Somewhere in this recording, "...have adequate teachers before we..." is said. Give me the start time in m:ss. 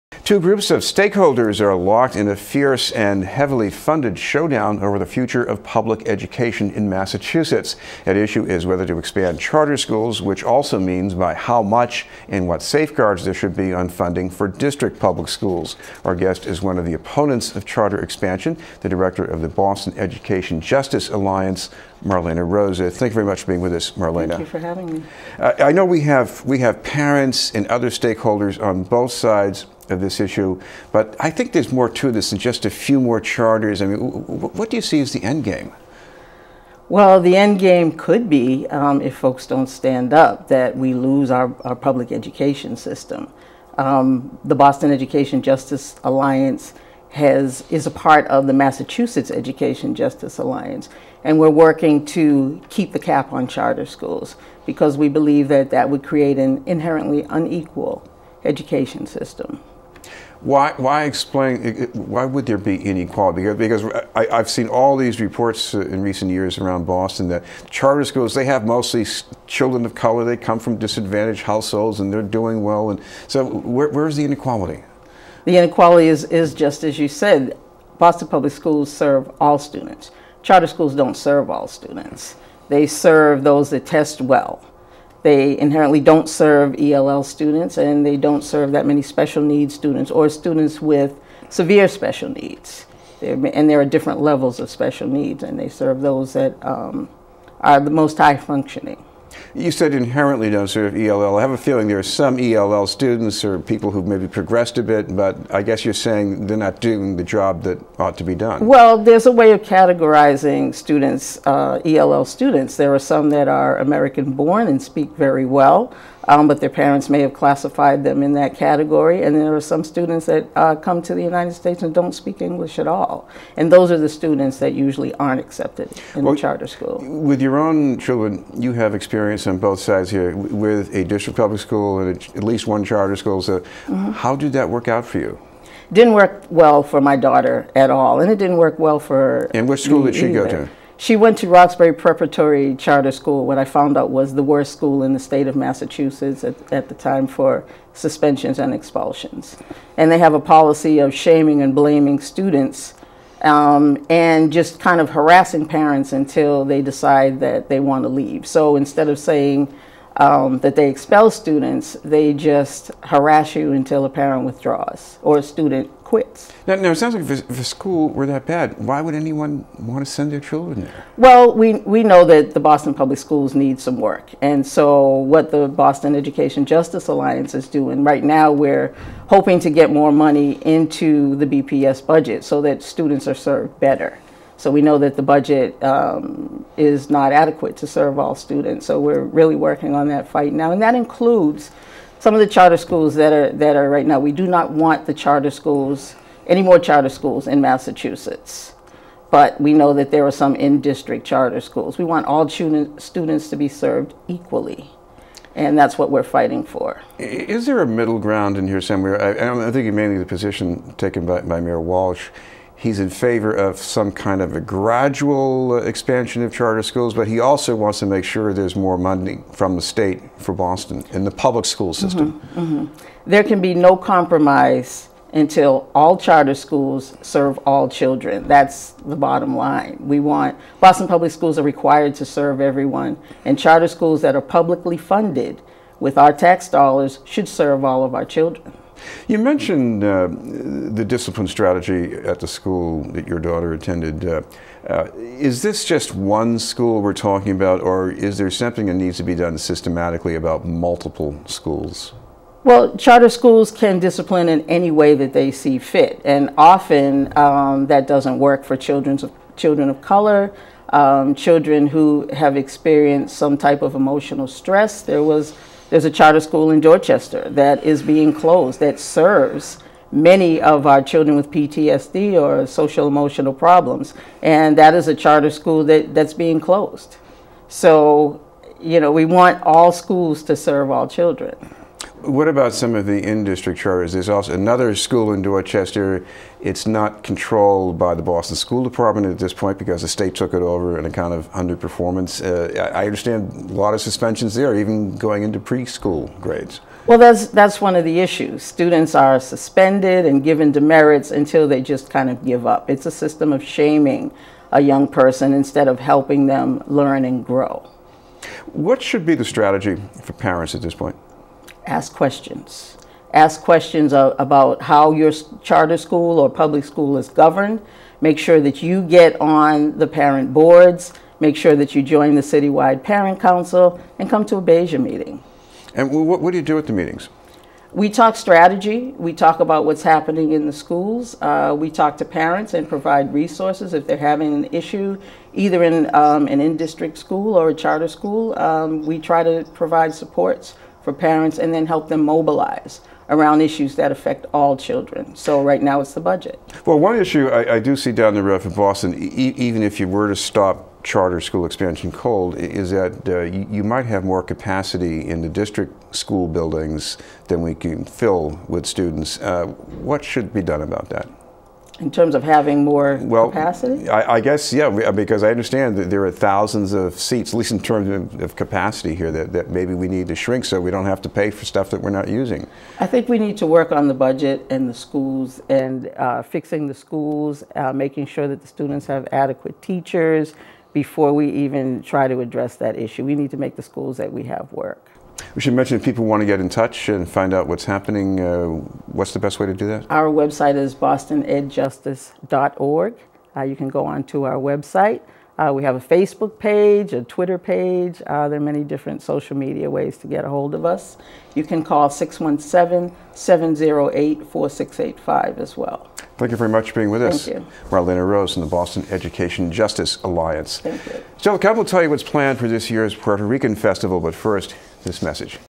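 6:19.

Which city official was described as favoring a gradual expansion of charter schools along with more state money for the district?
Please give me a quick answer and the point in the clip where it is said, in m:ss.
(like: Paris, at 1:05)
Mayor Walsh, at 3:31.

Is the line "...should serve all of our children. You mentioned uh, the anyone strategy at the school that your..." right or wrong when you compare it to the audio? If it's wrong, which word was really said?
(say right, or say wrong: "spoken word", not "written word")
wrong: "discipline", not "anyone".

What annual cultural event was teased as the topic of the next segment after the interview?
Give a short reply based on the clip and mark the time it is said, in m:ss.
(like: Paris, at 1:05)
Puerto Rican Festival, at 6:53.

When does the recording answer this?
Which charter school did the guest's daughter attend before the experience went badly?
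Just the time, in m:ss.
2:21.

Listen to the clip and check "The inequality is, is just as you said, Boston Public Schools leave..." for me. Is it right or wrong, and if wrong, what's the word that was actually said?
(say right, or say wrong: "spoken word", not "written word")
wrong: "serve", not "leave".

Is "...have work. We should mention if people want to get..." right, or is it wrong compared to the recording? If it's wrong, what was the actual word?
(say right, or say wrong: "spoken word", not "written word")
right.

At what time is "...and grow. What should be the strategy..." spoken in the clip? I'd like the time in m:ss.
5:07.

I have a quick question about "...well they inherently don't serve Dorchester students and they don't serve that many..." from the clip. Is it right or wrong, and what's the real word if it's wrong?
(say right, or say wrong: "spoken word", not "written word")
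wrong: "ELL", not "Dorchester".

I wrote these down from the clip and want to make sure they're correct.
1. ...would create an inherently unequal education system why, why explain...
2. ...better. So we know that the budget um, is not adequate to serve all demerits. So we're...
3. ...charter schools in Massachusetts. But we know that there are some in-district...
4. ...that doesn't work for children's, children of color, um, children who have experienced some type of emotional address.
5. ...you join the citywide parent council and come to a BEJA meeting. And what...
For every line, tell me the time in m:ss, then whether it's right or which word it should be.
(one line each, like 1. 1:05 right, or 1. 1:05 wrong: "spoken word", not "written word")
1. 0:55 right
2. 3:03 wrong: "students", not "demerits"
3. 3:16 right
4. 4:17 wrong: "stress", not "address"
5. 5:21 right.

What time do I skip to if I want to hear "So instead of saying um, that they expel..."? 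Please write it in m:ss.
2:38.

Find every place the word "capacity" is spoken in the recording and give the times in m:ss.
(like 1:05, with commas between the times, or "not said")
5:54, 6:03, 6:08.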